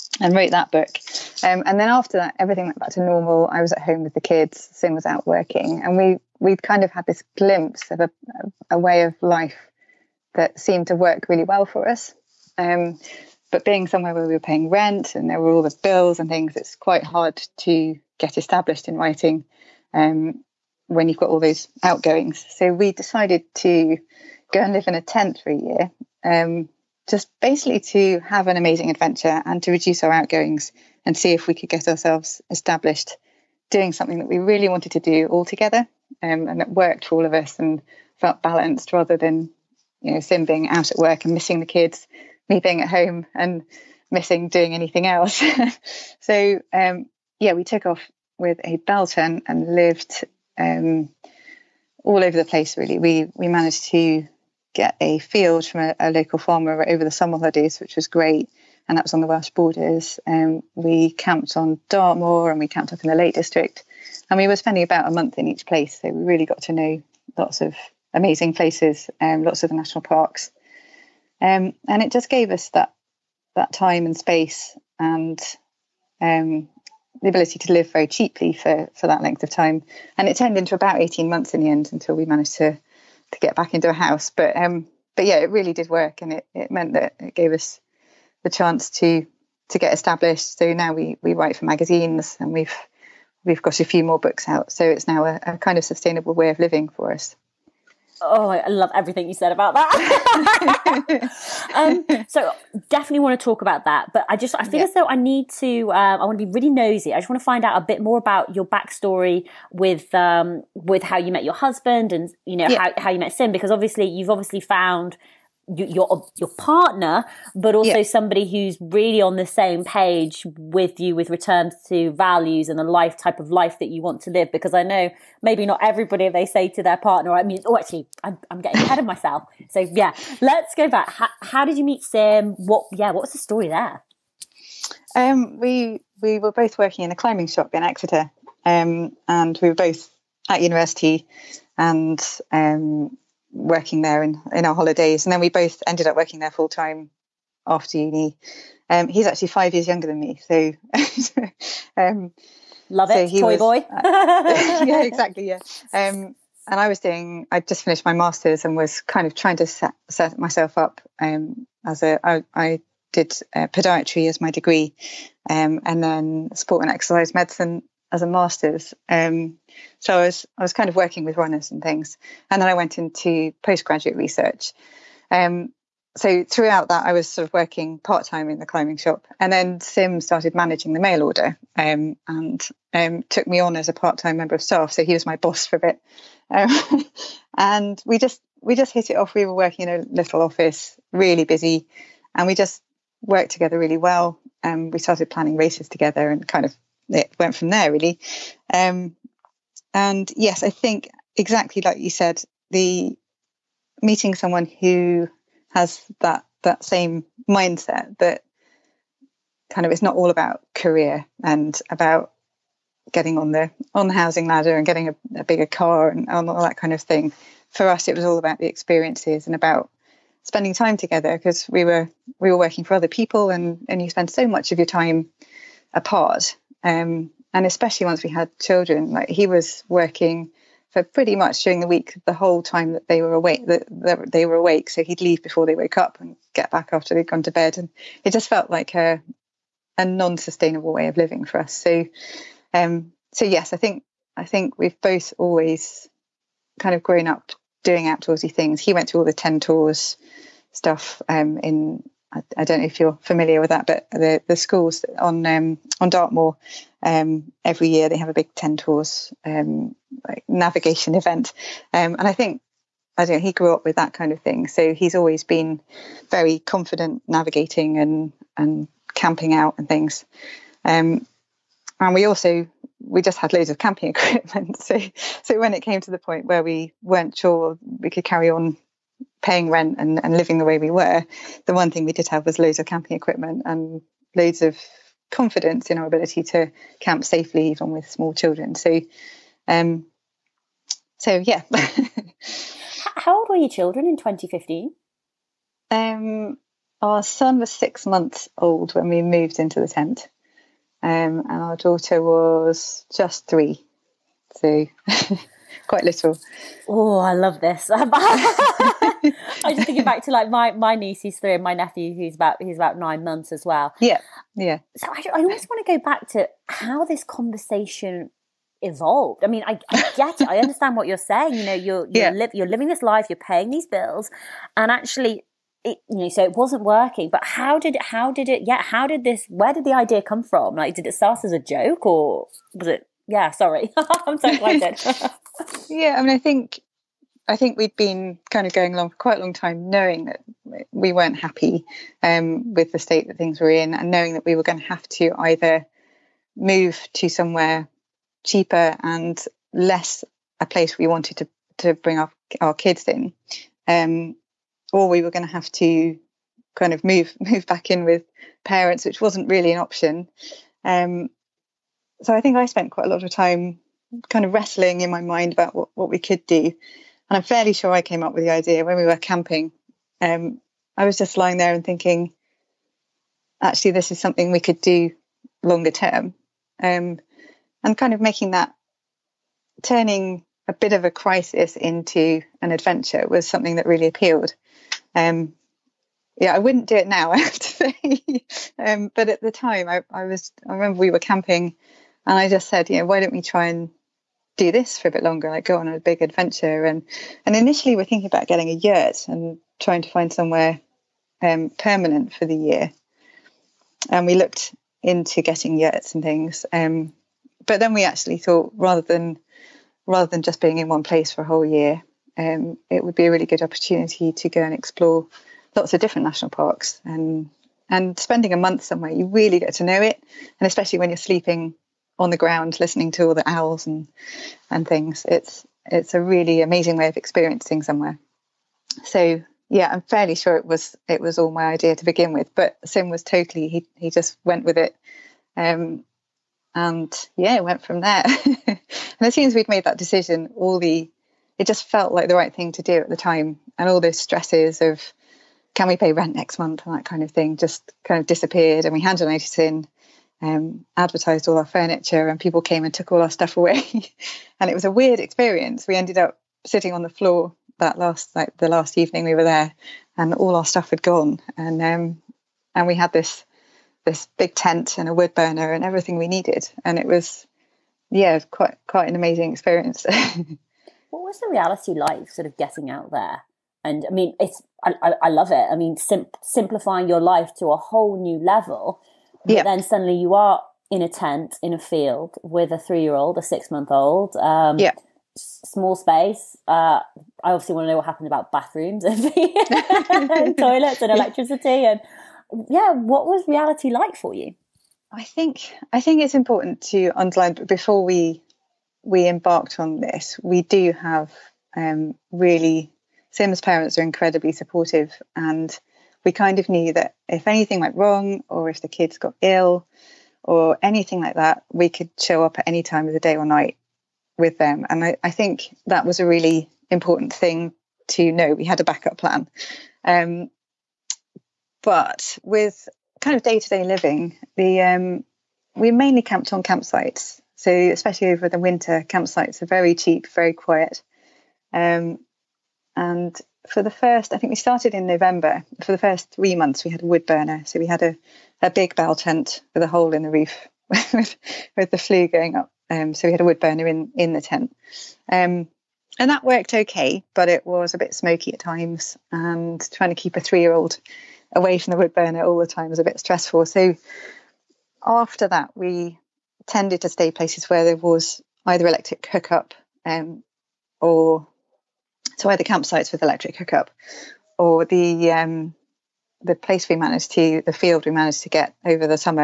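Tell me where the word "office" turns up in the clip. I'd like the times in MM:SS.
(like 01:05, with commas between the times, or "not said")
03:10.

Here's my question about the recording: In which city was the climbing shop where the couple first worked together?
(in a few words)
Exeter.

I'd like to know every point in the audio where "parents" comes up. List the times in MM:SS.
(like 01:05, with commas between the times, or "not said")
05:58, 08:23.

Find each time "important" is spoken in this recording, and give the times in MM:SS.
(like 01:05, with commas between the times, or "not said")
08:16, 08:36.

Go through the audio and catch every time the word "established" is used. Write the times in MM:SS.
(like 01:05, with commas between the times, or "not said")
00:18, 00:32, 01:29.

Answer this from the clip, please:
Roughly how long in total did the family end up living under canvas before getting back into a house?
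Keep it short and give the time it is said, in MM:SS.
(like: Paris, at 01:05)
18 months, at 01:21.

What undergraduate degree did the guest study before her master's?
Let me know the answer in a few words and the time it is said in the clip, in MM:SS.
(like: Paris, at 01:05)
Podiatry, at 02:43.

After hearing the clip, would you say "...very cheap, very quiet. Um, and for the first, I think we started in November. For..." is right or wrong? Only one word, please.
right.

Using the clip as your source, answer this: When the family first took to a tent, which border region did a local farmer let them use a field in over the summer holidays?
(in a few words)
Welsh borders.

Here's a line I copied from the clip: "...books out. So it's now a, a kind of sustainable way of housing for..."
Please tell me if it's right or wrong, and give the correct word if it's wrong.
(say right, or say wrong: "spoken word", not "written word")
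wrong: "living", not "housing".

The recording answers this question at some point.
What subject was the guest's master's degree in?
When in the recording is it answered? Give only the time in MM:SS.
02:46.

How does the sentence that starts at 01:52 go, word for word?
how, how you met Sim because obviously you've obviously found your your partner, but also yeah.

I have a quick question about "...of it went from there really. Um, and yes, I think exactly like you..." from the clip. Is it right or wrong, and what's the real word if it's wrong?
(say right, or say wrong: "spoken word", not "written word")
right.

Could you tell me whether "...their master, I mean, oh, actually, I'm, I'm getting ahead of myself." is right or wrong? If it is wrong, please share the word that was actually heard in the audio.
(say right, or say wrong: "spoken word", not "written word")
wrong: "partner", not "master".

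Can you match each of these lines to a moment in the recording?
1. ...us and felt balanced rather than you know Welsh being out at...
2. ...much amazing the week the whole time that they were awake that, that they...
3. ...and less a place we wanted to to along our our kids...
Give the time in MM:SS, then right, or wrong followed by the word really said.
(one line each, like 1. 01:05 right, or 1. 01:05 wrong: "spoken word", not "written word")
1. 00:37 wrong: "Sim", not "Welsh"
2. 03:51 wrong: "during", not "amazing"
3. 05:49 wrong: "bring", not "along".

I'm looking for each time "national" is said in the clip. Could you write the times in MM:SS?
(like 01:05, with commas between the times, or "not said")
01:09, 06:56.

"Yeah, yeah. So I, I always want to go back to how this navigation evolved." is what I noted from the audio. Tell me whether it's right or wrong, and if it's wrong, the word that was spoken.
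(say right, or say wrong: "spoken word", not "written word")
wrong: "conversation", not "navigation".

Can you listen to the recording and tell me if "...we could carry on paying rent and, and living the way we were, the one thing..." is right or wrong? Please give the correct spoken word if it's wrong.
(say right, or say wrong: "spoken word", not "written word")
right.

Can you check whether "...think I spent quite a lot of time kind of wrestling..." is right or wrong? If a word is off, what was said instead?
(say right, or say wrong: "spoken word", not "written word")
right.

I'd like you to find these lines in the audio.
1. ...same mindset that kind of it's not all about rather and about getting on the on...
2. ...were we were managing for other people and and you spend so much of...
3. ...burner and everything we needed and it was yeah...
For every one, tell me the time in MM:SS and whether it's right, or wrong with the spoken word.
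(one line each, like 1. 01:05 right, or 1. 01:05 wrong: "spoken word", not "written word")
1. 03:26 wrong: "career", not "rather"
2. 03:41 wrong: "working", not "managing"
3. 07:45 right.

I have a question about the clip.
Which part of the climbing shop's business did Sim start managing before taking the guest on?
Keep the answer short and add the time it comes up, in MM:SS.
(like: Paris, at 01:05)
Mail order, at 03:00.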